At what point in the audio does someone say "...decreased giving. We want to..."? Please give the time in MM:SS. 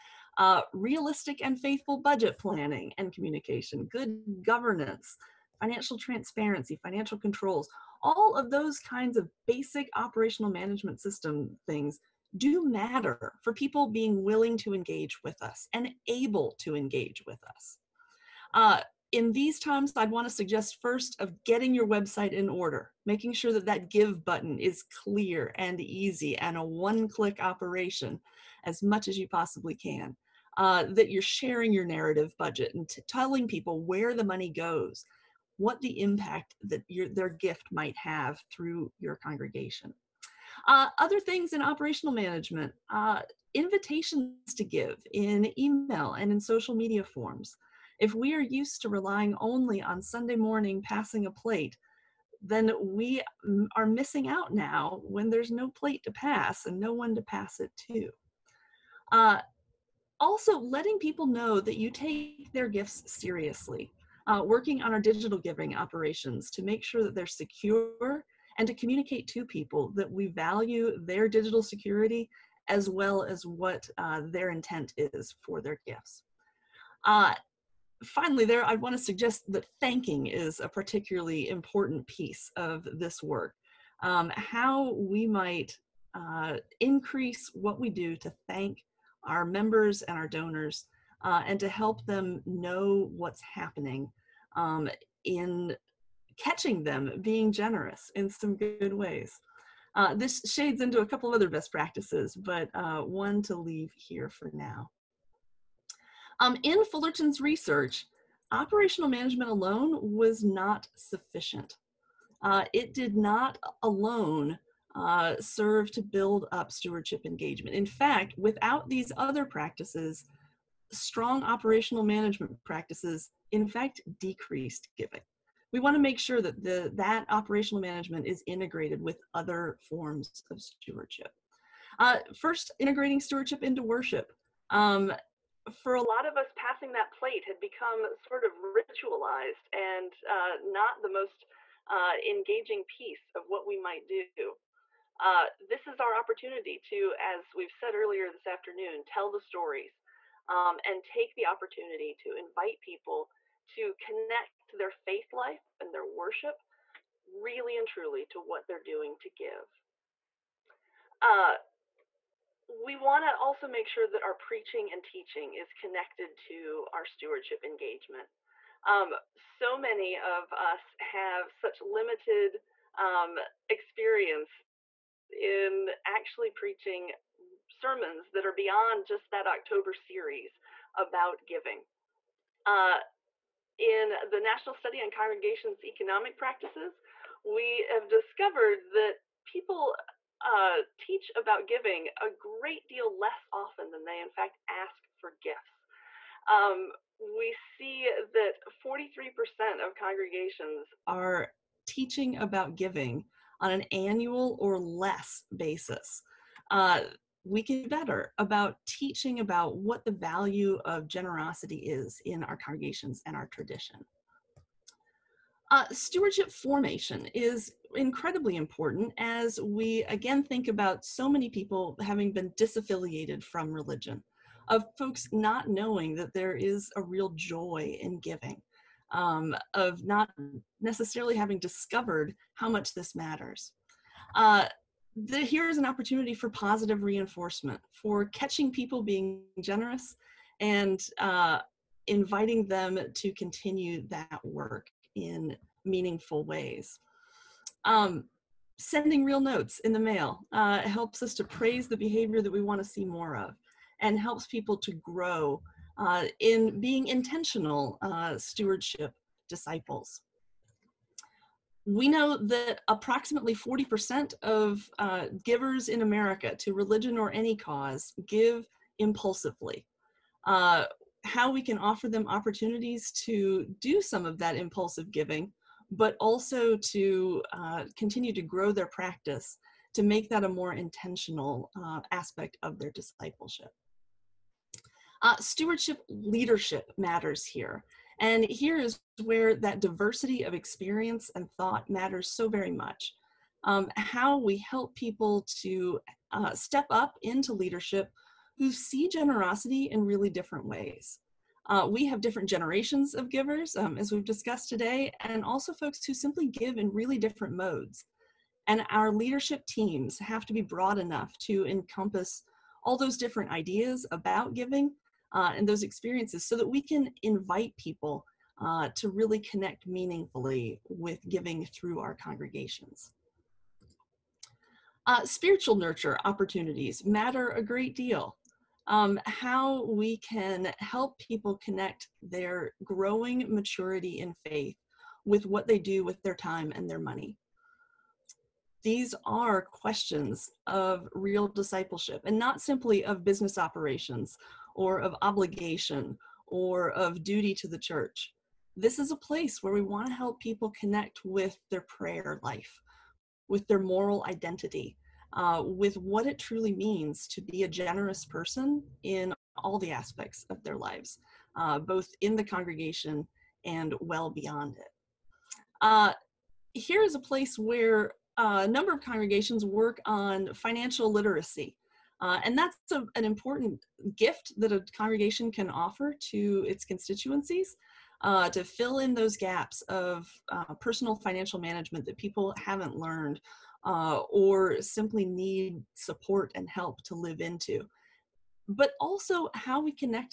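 02:04.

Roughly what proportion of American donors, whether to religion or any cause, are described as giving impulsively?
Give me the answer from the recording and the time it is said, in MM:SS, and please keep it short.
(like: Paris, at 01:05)
40%, at 04:23.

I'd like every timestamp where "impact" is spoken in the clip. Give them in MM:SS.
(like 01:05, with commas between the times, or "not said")
00:36.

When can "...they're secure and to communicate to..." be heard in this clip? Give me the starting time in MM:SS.
01:07.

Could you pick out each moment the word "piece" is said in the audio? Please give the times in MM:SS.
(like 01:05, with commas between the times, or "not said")
01:22, 02:22.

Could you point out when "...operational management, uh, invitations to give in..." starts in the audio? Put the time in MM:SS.
00:41.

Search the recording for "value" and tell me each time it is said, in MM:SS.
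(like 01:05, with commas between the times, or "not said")
01:10, 03:30.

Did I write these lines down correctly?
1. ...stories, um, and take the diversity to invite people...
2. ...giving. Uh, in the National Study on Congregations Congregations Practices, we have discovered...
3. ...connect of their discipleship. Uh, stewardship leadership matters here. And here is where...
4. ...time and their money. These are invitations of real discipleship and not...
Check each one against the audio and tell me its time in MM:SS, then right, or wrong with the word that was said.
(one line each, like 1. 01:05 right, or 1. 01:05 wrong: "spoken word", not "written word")
1. 02:29 wrong: "opportunity", not "diversity"
2. 03:01 wrong: "Economic", not "Congregations"
3. 04:42 wrong: "aspect", not "connect"
4. 05:36 wrong: "questions", not "invitations".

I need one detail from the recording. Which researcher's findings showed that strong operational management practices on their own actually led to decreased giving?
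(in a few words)
Fullerton.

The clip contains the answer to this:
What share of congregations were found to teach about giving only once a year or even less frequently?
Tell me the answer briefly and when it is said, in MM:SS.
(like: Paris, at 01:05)
43%, at 03:18.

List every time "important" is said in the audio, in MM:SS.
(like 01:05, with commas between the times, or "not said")
01:21, 03:38, 06:13.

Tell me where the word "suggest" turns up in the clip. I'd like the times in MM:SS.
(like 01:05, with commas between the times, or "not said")
00:20, 01:19.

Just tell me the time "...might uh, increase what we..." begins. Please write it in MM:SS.
01:25.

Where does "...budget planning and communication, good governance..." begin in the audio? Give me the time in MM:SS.
00:01.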